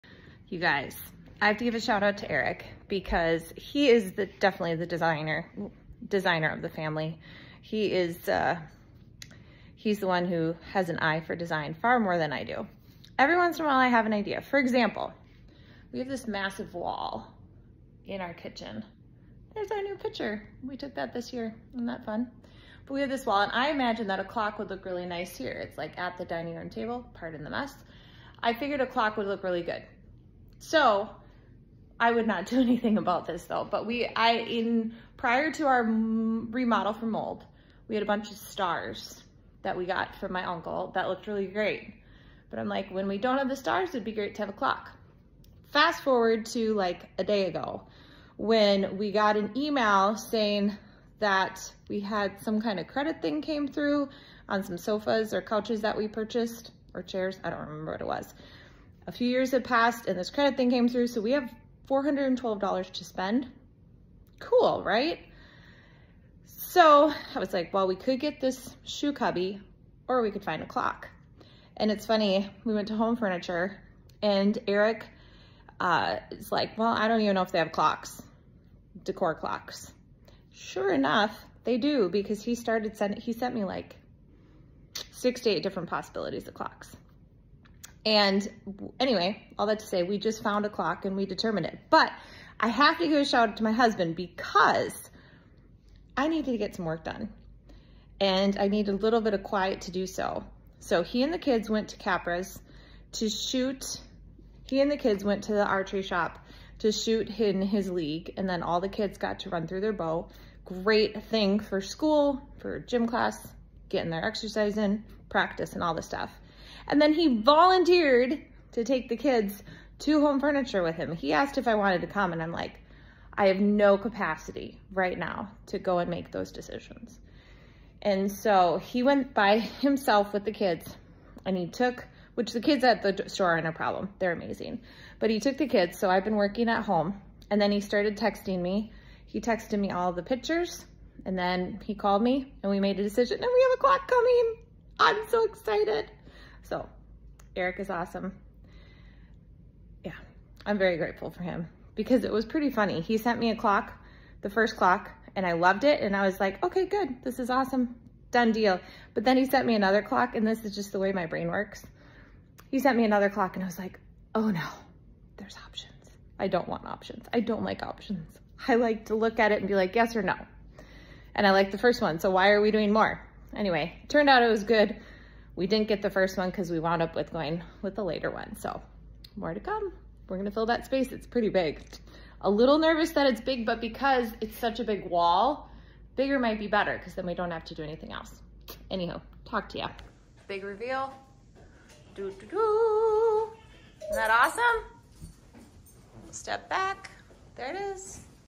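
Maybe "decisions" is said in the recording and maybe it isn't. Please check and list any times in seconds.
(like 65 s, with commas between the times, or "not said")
126 s, 143 s.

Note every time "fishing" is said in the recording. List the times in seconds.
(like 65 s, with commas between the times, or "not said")
not said.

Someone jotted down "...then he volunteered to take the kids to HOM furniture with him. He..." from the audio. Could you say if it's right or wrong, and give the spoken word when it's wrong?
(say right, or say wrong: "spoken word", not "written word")
right.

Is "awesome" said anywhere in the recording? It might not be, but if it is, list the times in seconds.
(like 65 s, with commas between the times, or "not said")
147 s, 157 s, 194 s.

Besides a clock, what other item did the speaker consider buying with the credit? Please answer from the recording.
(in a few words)
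shoe cubby.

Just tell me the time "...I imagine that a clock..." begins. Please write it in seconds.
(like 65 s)
23 s.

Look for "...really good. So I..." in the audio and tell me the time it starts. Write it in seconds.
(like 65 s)
29 s.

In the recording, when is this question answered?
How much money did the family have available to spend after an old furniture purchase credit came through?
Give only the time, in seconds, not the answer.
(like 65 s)
61 s.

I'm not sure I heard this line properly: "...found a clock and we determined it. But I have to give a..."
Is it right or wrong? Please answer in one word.
right.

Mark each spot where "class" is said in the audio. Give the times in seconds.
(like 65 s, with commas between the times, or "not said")
113 s.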